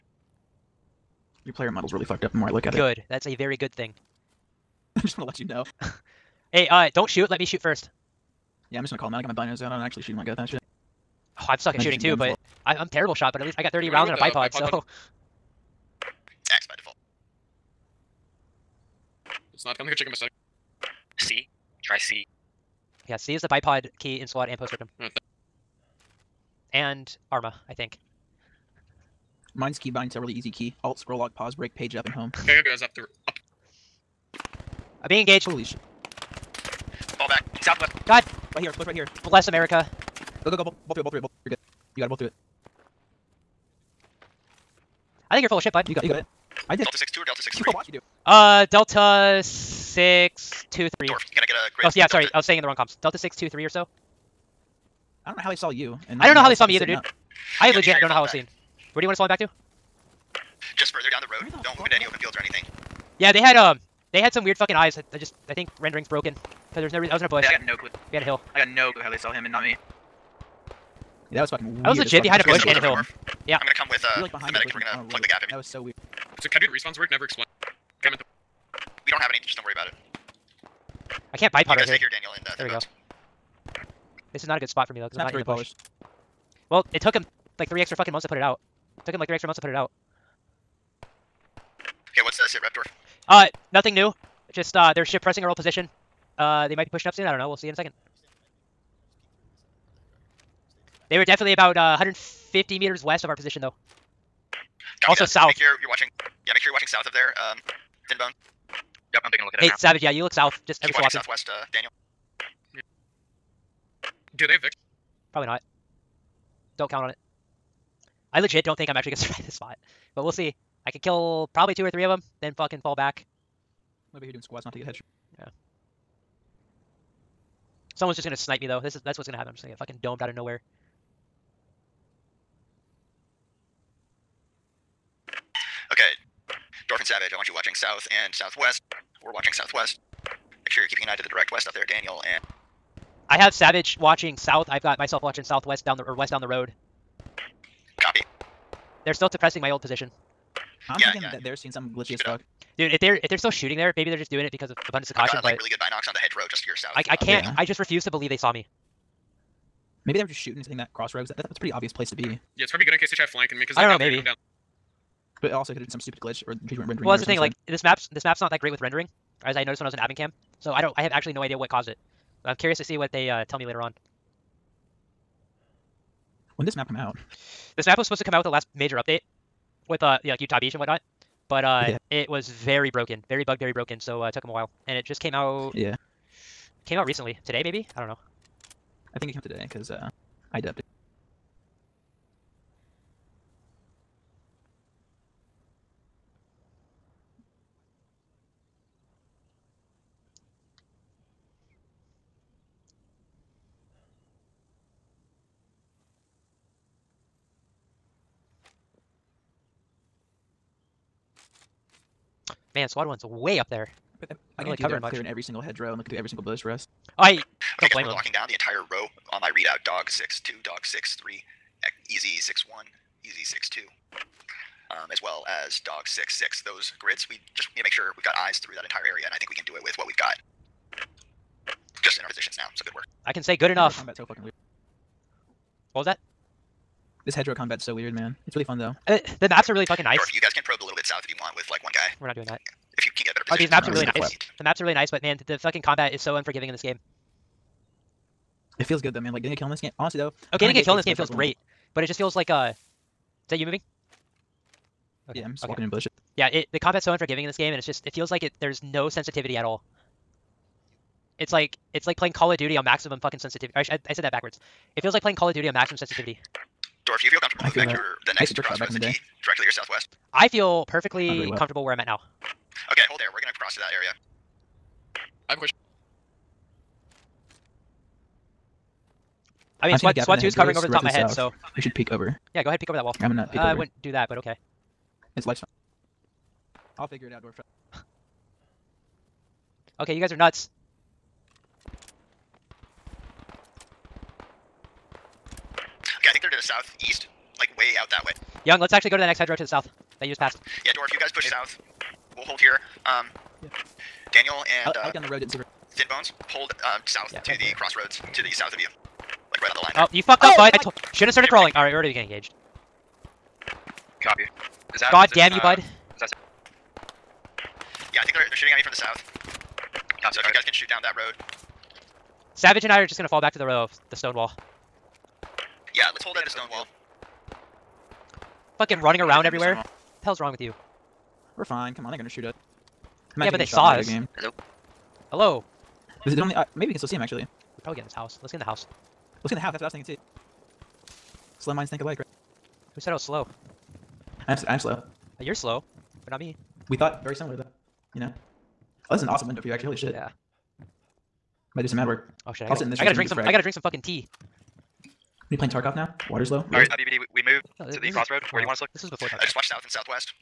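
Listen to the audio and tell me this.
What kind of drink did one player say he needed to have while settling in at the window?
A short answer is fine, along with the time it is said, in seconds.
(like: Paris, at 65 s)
Tea, at 354 s.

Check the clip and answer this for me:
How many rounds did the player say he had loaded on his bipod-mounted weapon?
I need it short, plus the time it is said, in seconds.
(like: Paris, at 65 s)
30, at 13 s.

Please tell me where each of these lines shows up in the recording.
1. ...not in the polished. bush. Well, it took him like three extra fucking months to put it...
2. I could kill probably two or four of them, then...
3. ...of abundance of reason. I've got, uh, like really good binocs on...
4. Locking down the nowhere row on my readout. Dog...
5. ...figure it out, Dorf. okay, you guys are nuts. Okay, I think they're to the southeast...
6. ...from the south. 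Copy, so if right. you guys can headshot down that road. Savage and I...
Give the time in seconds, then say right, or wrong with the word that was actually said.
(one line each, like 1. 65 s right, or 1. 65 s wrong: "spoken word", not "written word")
1. 85 s right
2. 120 s wrong: "three", not "four"
3. 154 s wrong: "caution", not "reason"
4. 218 s wrong: "entire", not "nowhere"
5. 287 s right
6. 318 s wrong: "shoot", not "headshot".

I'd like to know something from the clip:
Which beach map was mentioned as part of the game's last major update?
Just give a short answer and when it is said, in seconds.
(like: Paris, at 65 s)
Utah Beach, at 180 s.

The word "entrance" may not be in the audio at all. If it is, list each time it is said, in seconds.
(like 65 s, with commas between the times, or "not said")
not said.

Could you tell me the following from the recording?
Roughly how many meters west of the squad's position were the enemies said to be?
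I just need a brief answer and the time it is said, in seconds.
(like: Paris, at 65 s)
150, at 101 s.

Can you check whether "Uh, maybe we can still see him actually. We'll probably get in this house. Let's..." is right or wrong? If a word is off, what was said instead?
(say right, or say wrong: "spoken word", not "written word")
right.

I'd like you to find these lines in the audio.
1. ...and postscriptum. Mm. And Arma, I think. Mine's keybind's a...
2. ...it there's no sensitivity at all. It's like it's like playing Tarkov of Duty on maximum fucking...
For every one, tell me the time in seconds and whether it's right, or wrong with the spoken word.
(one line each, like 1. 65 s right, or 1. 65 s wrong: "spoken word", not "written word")
1. 24 s right
2. 258 s wrong: "Call", not "Tarkov".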